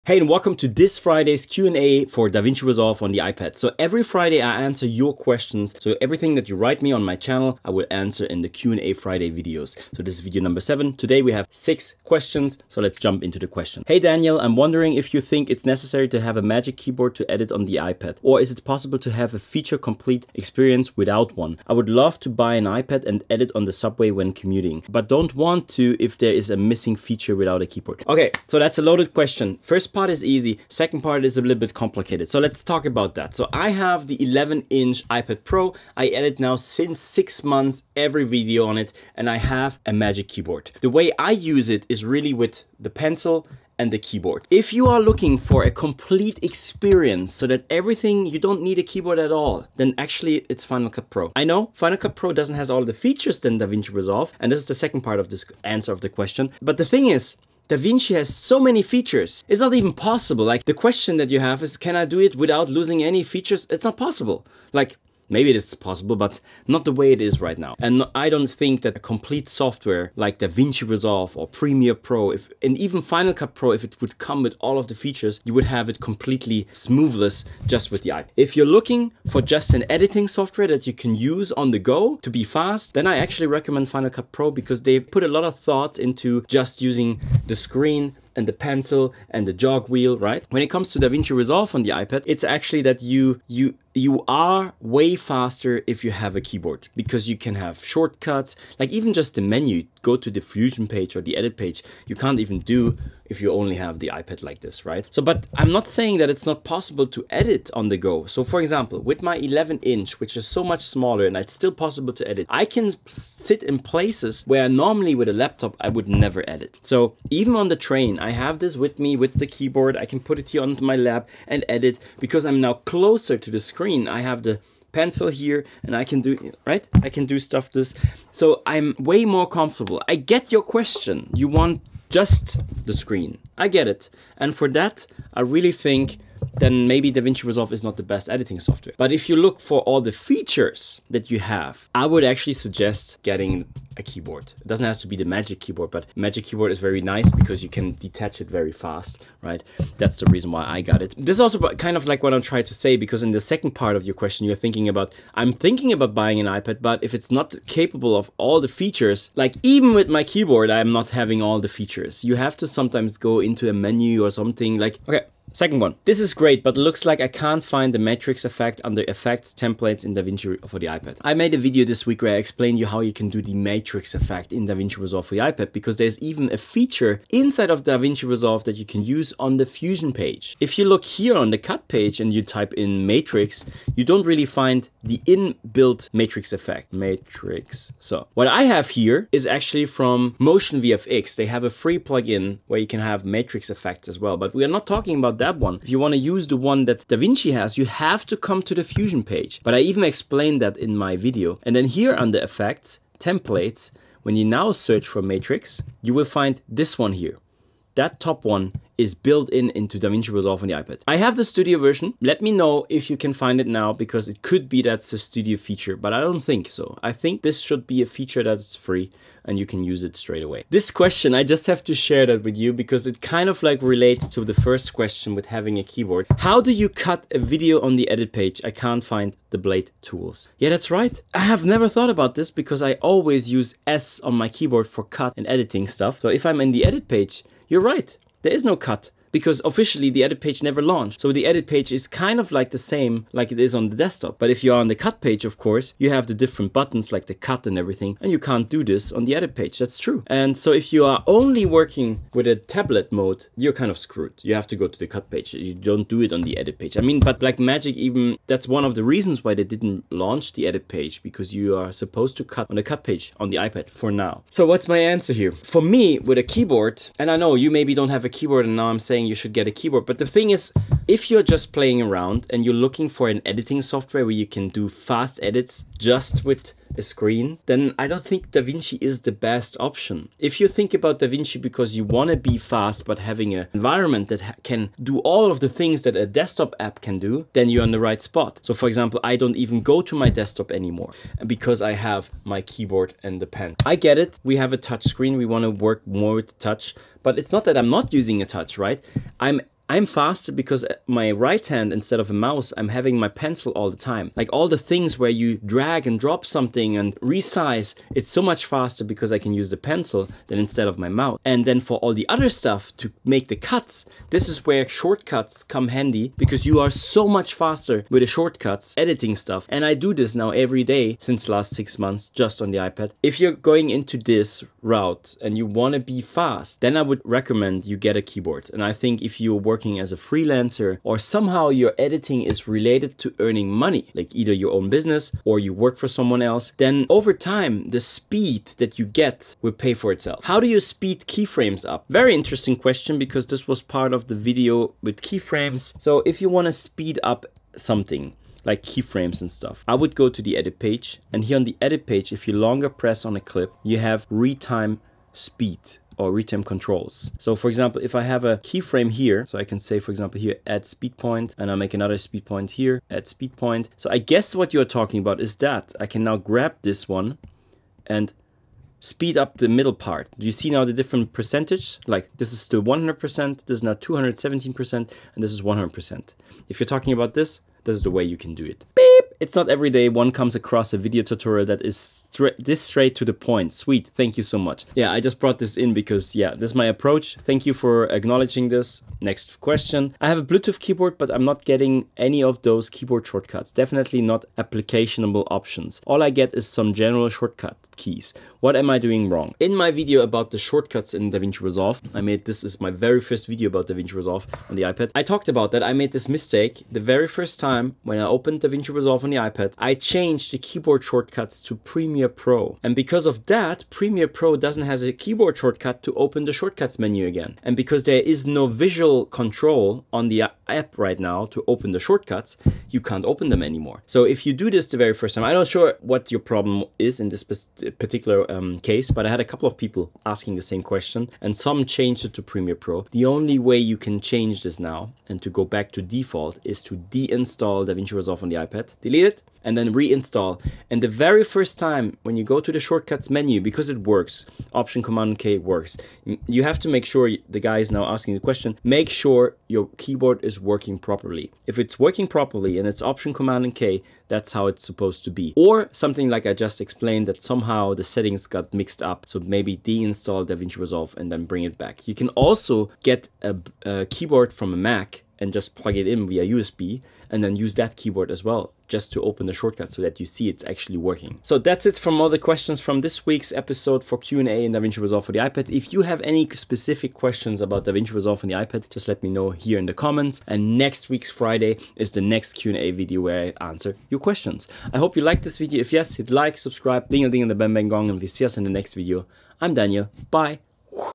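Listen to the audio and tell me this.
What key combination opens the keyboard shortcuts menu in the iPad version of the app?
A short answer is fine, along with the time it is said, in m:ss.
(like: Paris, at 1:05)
Option Command K, at 7:24.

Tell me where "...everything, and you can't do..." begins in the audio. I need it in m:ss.
4:07.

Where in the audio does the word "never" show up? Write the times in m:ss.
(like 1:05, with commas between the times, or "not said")
1:56, 3:51, 4:00.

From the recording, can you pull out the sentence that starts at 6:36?
All I get is some general shortcut keys.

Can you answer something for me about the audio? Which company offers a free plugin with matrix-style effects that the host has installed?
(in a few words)
Motion VFX.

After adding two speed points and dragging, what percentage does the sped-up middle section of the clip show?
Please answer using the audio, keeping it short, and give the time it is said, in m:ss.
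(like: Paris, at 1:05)
217%, at 6:13.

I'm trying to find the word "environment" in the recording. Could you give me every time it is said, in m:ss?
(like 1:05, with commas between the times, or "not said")
4:43.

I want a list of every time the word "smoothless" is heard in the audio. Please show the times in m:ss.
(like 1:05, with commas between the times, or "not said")
1:16.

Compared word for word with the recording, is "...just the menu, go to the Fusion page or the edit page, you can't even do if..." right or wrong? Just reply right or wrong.
right.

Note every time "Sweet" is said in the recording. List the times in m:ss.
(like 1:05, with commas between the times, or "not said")
6:23.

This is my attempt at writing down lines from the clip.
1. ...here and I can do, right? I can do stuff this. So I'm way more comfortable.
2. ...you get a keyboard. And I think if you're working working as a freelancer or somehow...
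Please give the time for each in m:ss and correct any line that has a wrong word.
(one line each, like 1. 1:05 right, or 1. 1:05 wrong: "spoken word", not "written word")
1. 2:05 right
2. 5:27 right.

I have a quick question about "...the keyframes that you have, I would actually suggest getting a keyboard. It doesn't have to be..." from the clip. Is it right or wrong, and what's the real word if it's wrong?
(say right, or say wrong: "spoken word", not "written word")
wrong: "features", not "keyframes".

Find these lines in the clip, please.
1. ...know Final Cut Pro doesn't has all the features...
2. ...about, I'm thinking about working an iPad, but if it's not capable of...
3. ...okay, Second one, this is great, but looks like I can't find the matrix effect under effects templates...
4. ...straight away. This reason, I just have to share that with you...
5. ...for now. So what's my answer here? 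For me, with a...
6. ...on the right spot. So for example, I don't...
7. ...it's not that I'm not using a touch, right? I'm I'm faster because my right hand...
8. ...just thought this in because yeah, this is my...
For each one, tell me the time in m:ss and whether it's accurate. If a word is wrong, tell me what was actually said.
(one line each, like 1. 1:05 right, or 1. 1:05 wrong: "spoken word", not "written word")
1. 0:51 right
2. 2:34 wrong: "buying", not "working"
3. 2:45 right
4. 3:40 wrong: "question", not "reason"
5. 4:23 right
6. 4:47 right
7. 4:57 right
8. 6:25 wrong: "brought", not "thought".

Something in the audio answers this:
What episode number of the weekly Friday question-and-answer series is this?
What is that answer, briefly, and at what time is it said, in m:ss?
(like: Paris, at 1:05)
7, at 0:10.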